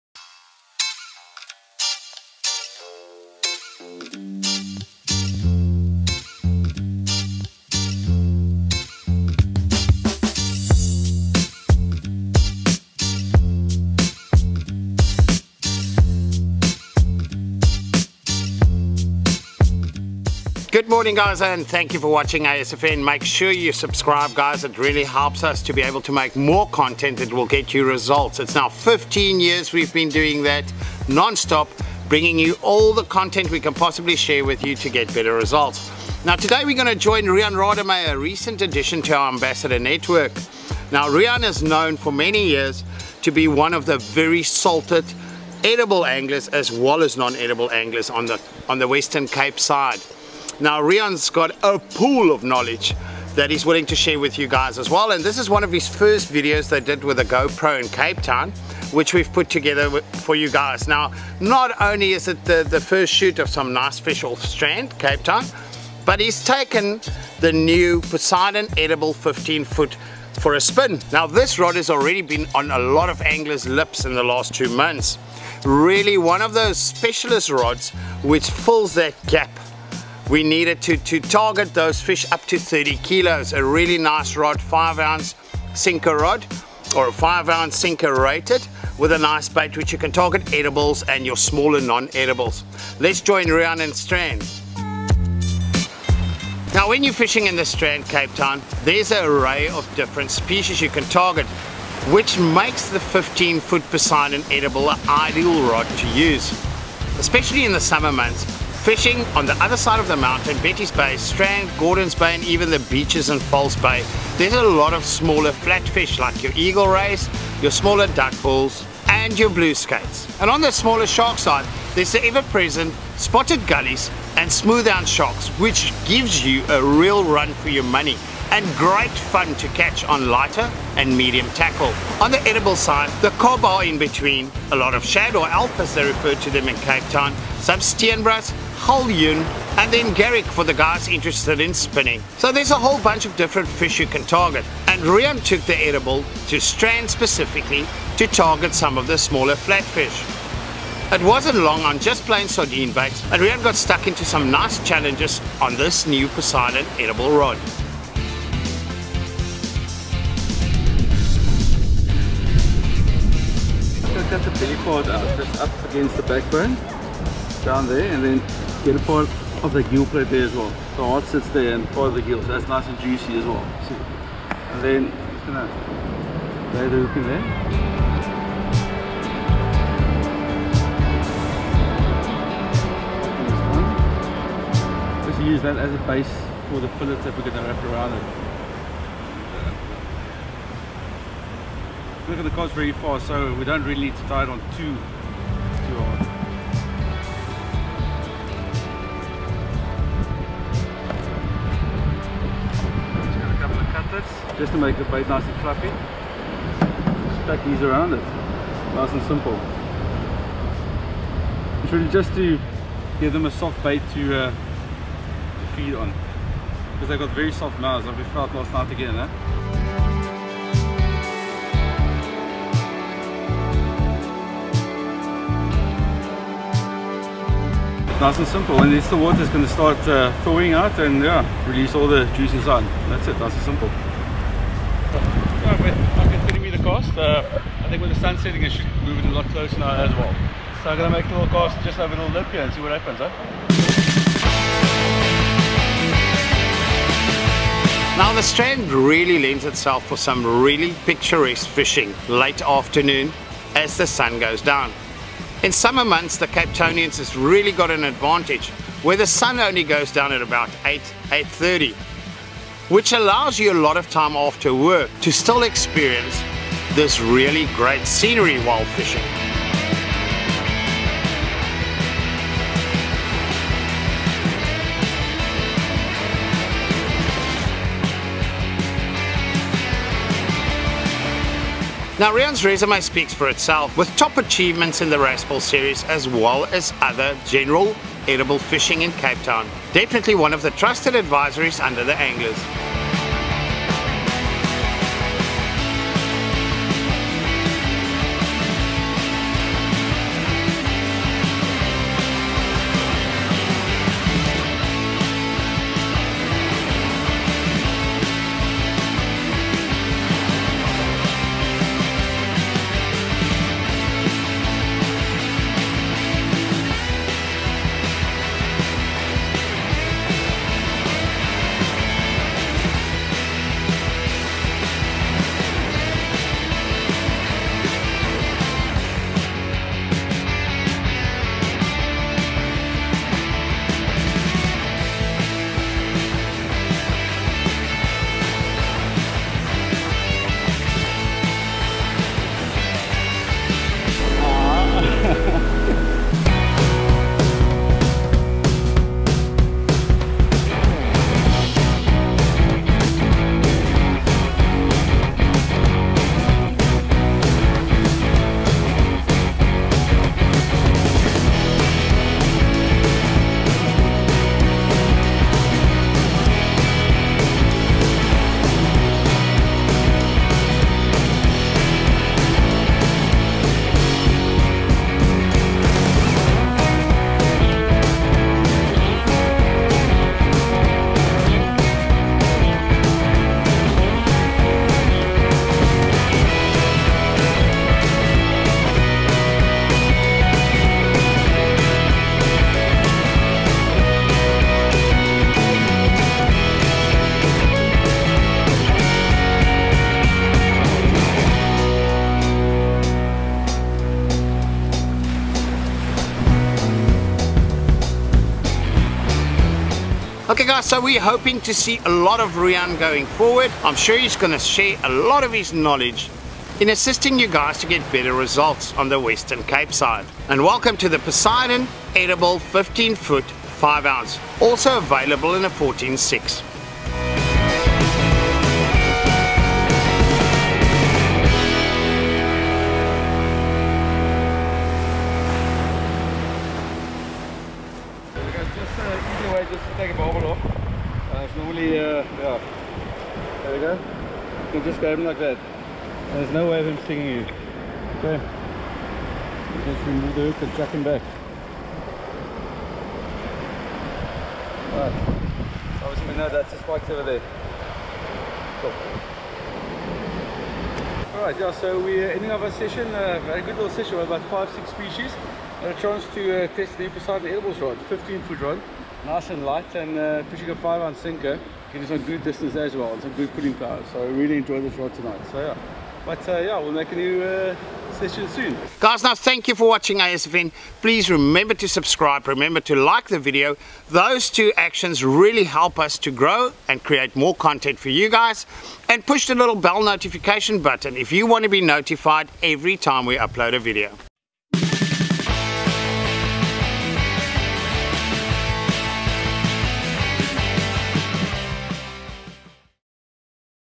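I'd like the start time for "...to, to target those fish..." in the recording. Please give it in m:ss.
1:20.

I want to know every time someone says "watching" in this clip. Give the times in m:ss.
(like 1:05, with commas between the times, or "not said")
0:22, 7:59.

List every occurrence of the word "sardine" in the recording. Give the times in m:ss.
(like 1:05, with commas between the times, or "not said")
2:32.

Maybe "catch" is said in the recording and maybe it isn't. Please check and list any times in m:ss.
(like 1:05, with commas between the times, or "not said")
2:09.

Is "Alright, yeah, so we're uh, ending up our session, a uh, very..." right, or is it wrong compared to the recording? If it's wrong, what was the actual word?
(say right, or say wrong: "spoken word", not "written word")
right.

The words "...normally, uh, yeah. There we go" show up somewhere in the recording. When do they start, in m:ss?
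7:21.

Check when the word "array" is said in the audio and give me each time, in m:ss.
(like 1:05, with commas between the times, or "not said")
1:39.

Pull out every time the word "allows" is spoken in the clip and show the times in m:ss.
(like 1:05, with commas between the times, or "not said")
4:23.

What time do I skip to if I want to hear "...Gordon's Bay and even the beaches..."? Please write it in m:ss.
1:51.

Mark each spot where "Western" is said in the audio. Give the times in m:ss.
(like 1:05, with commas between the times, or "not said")
0:48, 6:59.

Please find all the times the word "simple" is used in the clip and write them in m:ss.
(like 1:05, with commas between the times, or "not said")
3:29, 3:48, 3:53.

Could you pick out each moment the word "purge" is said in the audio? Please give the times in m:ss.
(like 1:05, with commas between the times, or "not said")
not said.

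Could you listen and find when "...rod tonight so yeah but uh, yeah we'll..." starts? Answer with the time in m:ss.
7:54.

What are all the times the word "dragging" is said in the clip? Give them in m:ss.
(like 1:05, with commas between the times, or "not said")
not said.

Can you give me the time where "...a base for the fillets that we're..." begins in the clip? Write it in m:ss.
3:05.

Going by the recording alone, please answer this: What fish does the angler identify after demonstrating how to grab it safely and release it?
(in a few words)
spike.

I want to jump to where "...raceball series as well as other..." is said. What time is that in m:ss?
4:45.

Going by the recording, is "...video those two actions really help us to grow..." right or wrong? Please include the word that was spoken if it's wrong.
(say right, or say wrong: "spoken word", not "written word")
right.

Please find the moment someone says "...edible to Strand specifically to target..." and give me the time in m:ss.
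2:25.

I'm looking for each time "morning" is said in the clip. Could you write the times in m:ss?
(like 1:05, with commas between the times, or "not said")
0:20.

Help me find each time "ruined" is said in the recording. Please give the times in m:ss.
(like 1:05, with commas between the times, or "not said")
not said.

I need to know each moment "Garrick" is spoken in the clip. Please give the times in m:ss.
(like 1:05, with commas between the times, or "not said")
2:20.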